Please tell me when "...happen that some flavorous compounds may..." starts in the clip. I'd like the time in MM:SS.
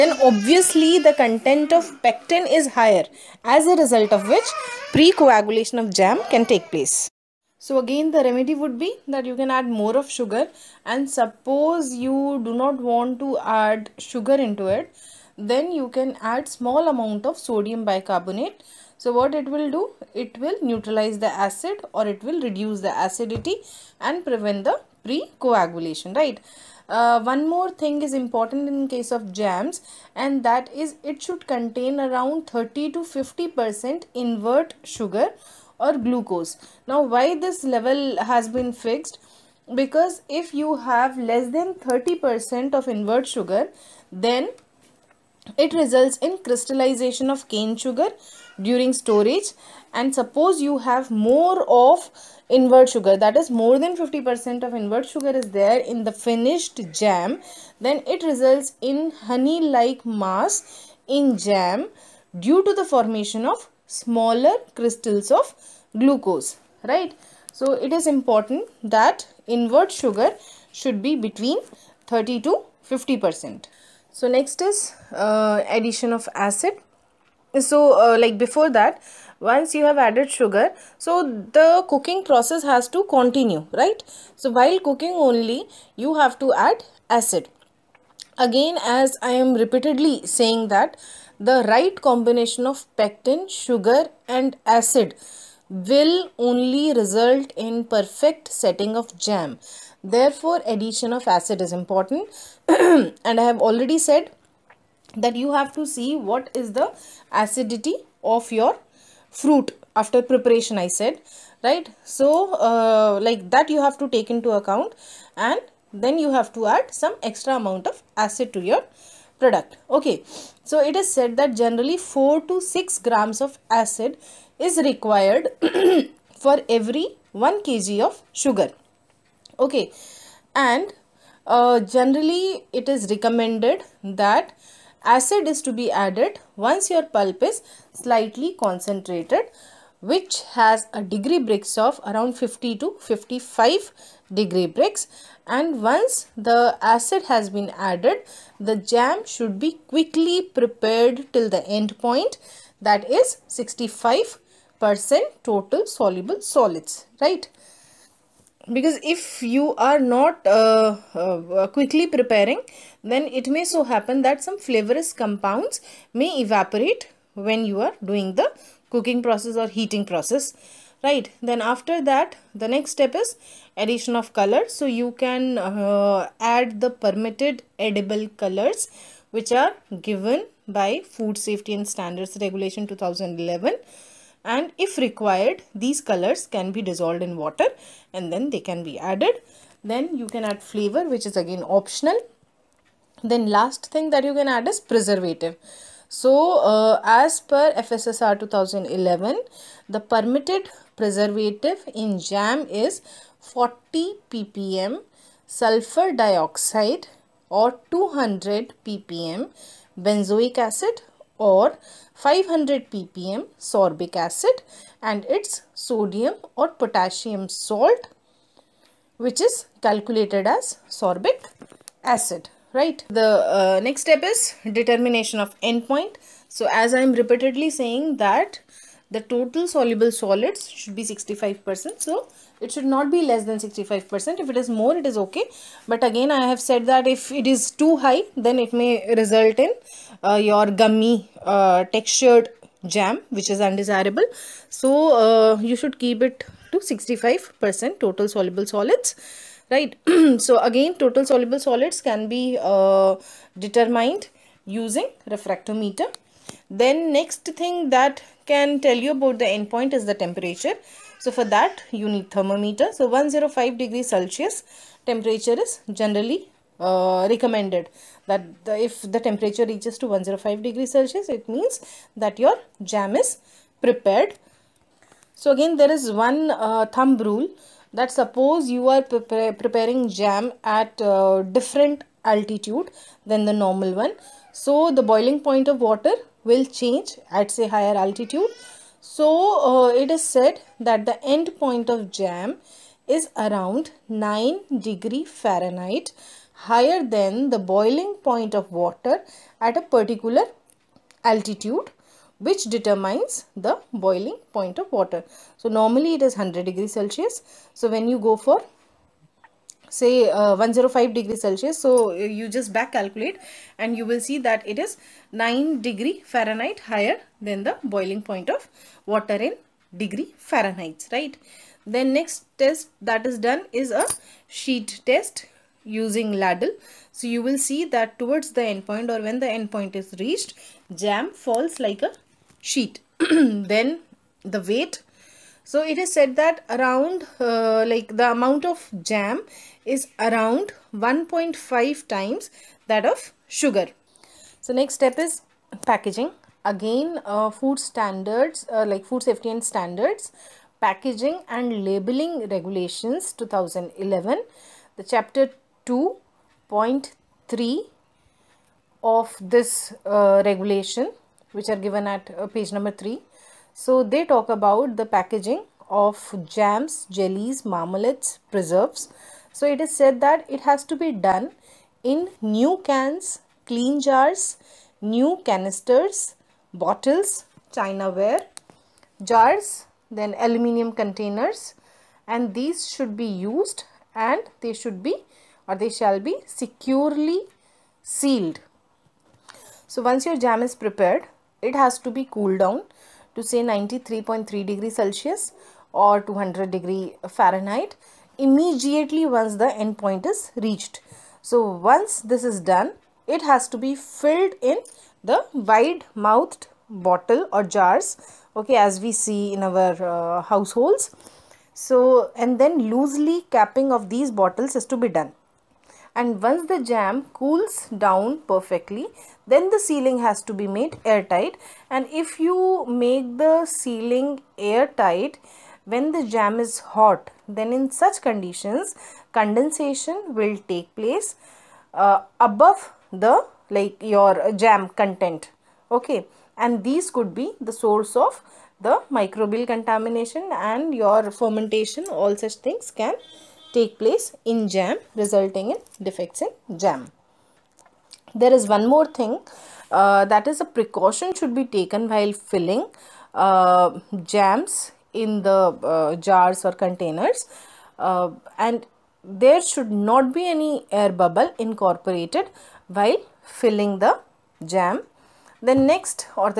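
02:43.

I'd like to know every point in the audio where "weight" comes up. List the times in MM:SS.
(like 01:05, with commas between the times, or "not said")
05:34.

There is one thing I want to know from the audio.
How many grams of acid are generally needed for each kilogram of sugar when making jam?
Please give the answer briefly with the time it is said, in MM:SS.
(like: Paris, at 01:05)
4 to 6 grams, at 02:01.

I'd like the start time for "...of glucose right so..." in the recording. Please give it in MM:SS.
01:05.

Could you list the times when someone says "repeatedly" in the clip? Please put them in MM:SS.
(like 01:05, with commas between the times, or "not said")
01:29, 03:47.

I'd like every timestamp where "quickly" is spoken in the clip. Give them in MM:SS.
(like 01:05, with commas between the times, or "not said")
02:29, 02:41.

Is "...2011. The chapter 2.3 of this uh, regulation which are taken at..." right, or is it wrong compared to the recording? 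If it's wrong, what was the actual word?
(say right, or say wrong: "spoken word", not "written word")
wrong: "given", not "taken".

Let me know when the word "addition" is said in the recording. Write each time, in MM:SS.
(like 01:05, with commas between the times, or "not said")
01:15, 01:40, 02:53.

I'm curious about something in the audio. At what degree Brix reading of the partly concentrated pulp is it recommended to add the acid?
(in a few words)
50 to 55.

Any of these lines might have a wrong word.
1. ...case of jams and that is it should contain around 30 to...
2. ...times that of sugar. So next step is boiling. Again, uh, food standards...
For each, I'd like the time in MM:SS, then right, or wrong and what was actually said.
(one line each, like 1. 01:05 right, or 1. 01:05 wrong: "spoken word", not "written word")
1. 00:28 right
2. 05:42 wrong: "packaging", not "boiling".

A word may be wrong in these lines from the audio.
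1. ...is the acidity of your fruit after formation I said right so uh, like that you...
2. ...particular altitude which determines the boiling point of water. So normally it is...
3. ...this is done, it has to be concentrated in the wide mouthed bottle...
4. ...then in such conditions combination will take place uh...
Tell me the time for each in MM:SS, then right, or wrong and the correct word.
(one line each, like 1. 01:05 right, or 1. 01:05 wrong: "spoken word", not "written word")
1. 01:46 wrong: "preparation", not "formation"
2. 04:59 right
3. 06:42 wrong: "filled", not "concentrated"
4. 07:07 wrong: "condensation", not "combination".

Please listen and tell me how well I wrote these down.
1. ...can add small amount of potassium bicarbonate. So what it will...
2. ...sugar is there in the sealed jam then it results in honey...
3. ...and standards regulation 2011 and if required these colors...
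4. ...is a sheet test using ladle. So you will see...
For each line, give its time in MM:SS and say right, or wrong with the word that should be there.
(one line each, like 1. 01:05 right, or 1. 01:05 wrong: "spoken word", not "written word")
1. 00:15 wrong: "sodium", not "potassium"
2. 00:55 wrong: "finished", not "sealed"
3. 03:01 right
4. 05:23 right.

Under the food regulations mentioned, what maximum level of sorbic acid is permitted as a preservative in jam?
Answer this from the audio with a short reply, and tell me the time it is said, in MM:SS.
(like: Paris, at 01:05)
500 ppm, at 03:32.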